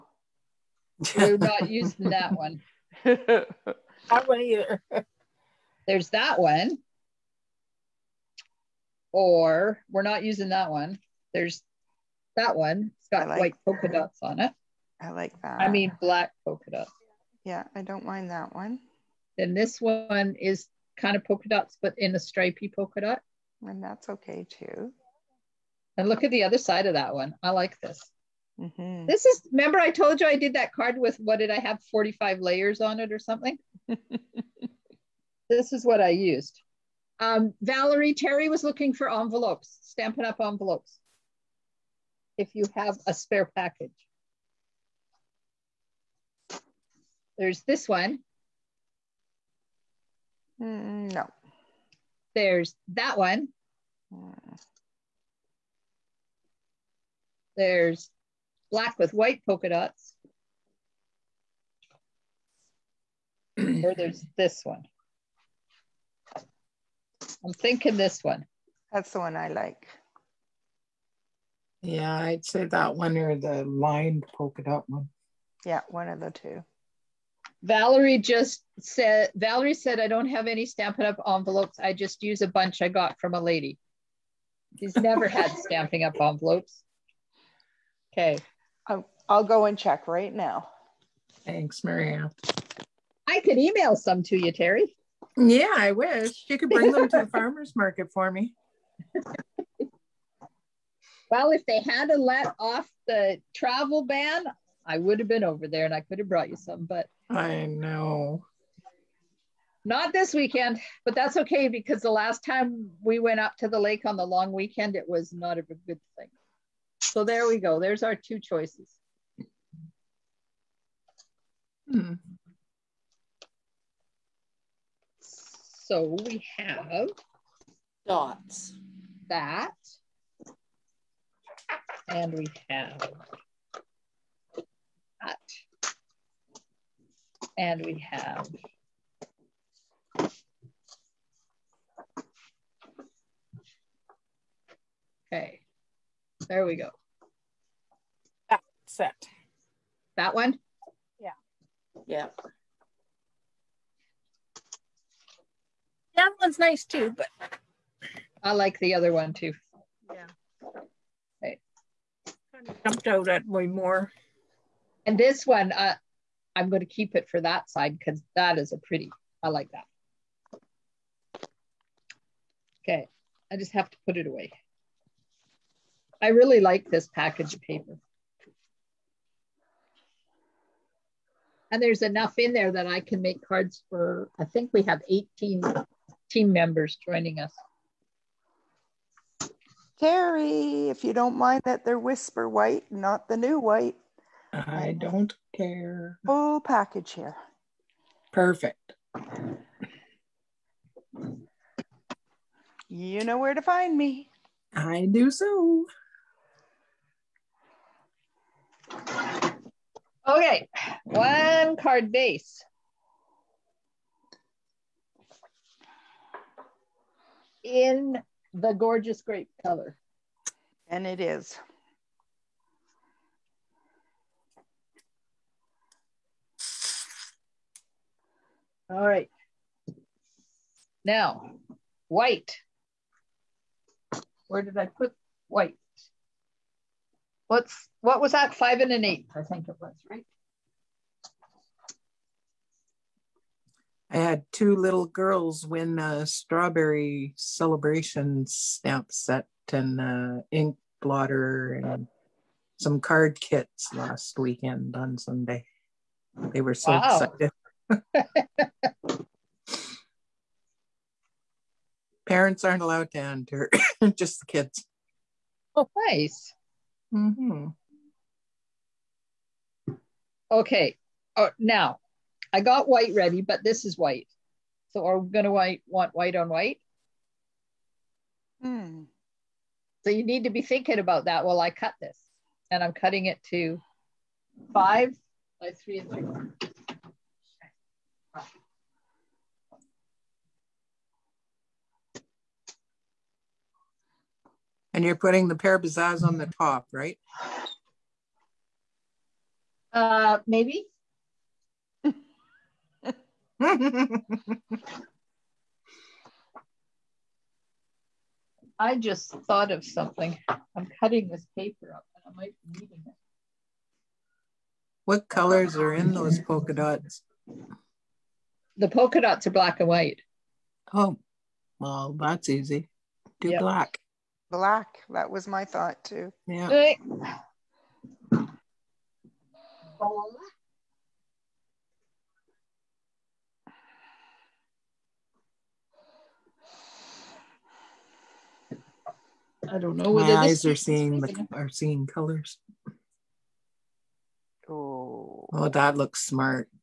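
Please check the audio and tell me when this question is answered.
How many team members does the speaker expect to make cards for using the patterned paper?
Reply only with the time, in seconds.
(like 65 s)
185 s.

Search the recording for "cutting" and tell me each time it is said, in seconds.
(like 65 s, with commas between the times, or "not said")
282 s, 311 s.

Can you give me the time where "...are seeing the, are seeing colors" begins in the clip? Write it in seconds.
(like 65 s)
340 s.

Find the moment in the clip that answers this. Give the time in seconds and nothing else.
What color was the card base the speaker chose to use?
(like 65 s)
218 s.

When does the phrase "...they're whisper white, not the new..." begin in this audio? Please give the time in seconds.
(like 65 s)
191 s.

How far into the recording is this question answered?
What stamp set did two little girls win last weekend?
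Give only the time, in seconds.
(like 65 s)
246 s.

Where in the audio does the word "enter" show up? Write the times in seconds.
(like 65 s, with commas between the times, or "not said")
263 s.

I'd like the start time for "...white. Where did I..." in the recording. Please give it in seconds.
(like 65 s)
232 s.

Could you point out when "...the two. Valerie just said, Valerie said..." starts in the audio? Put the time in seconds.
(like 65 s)
76 s.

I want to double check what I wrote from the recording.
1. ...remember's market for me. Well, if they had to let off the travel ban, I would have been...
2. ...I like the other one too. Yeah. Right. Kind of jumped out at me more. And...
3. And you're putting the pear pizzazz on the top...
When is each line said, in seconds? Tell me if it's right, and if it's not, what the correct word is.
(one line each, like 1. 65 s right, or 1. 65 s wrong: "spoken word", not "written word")
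1. 97 s wrong: "farmer", not "remember"
2. 158 s right
3. 294 s right.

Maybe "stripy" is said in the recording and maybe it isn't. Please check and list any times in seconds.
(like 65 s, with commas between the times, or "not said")
22 s.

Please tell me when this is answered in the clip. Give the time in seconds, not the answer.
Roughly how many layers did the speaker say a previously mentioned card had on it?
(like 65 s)
31 s.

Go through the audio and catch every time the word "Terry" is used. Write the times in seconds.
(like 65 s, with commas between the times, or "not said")
38 s, 94 s, 189 s.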